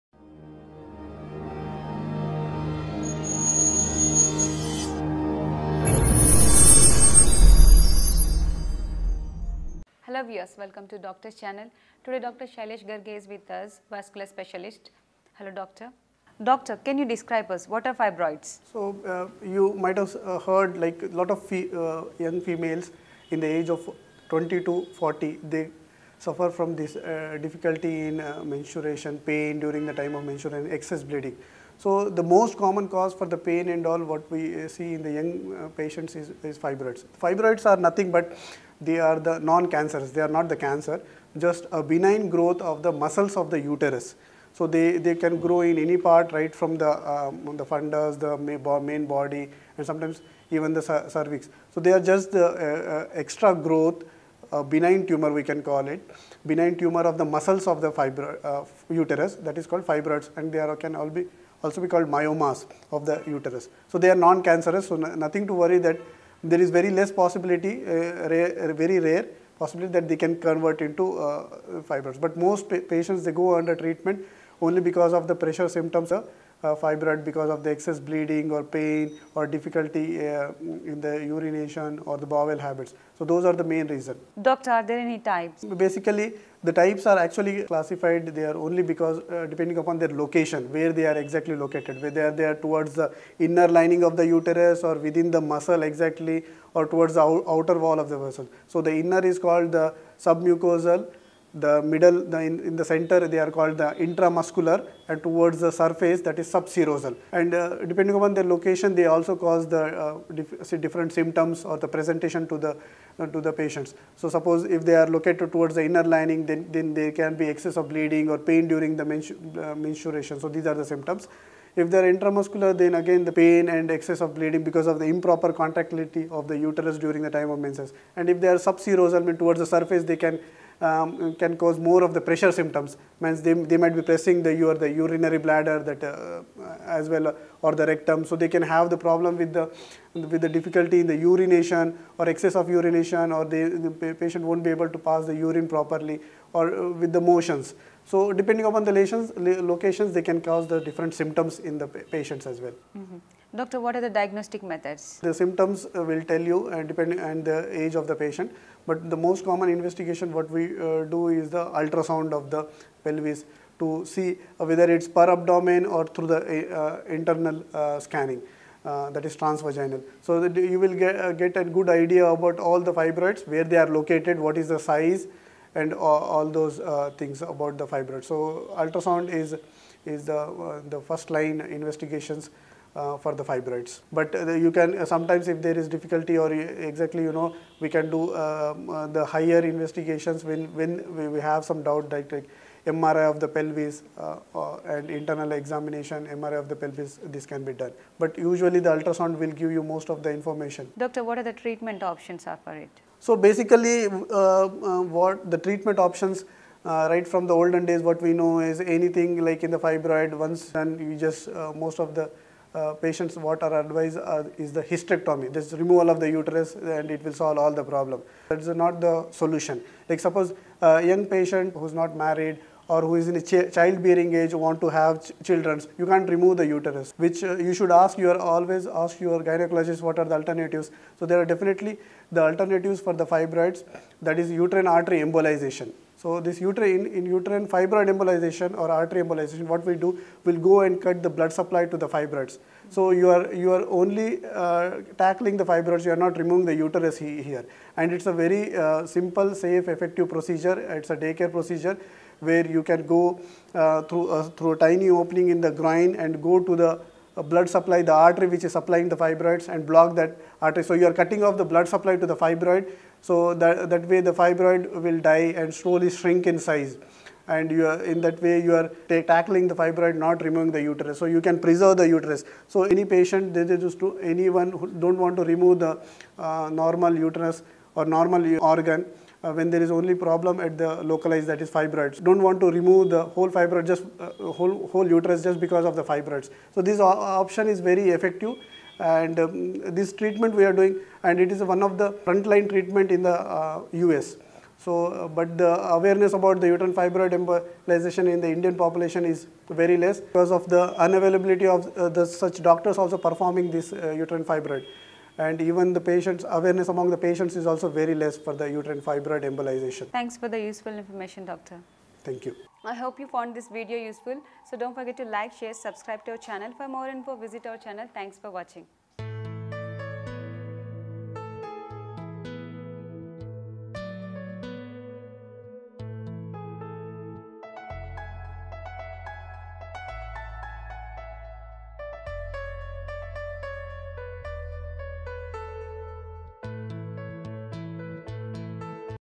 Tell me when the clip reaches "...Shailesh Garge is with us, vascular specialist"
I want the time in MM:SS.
00:12.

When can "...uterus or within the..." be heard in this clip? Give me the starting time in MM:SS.
01:34.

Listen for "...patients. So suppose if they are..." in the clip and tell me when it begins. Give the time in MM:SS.
01:53.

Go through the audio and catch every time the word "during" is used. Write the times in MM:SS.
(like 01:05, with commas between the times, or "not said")
00:29, 01:58, 02:06.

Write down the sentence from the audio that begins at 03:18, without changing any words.
But usually the ultrasound will give you most of the information.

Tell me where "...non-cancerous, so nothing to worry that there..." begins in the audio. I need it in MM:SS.
01:04.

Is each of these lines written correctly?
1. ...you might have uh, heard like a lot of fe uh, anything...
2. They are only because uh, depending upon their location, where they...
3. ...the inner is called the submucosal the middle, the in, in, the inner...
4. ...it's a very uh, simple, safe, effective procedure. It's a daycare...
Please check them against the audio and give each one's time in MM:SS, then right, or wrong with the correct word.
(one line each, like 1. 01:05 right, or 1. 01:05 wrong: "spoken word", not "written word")
1. 00:19 wrong: "young", not "anything"
2. 01:28 right
3. 01:38 wrong: "center", not "inner"
4. 04:08 right.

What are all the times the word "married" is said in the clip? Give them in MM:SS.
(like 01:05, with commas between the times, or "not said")
03:42.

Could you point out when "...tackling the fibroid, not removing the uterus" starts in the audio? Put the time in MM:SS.
04:29.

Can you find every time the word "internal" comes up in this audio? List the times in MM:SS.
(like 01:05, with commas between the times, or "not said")
02:47, 03:15.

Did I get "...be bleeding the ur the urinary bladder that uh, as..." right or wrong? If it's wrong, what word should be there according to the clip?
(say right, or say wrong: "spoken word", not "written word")
wrong: "pressing", not "bleeding".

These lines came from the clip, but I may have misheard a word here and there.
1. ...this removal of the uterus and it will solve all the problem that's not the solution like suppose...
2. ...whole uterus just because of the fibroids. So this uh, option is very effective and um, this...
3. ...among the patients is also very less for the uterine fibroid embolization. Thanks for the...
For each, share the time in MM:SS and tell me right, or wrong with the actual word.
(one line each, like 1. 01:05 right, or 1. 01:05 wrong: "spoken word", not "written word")
1. 03:35 right
2. 04:44 right
3. 05:06 right.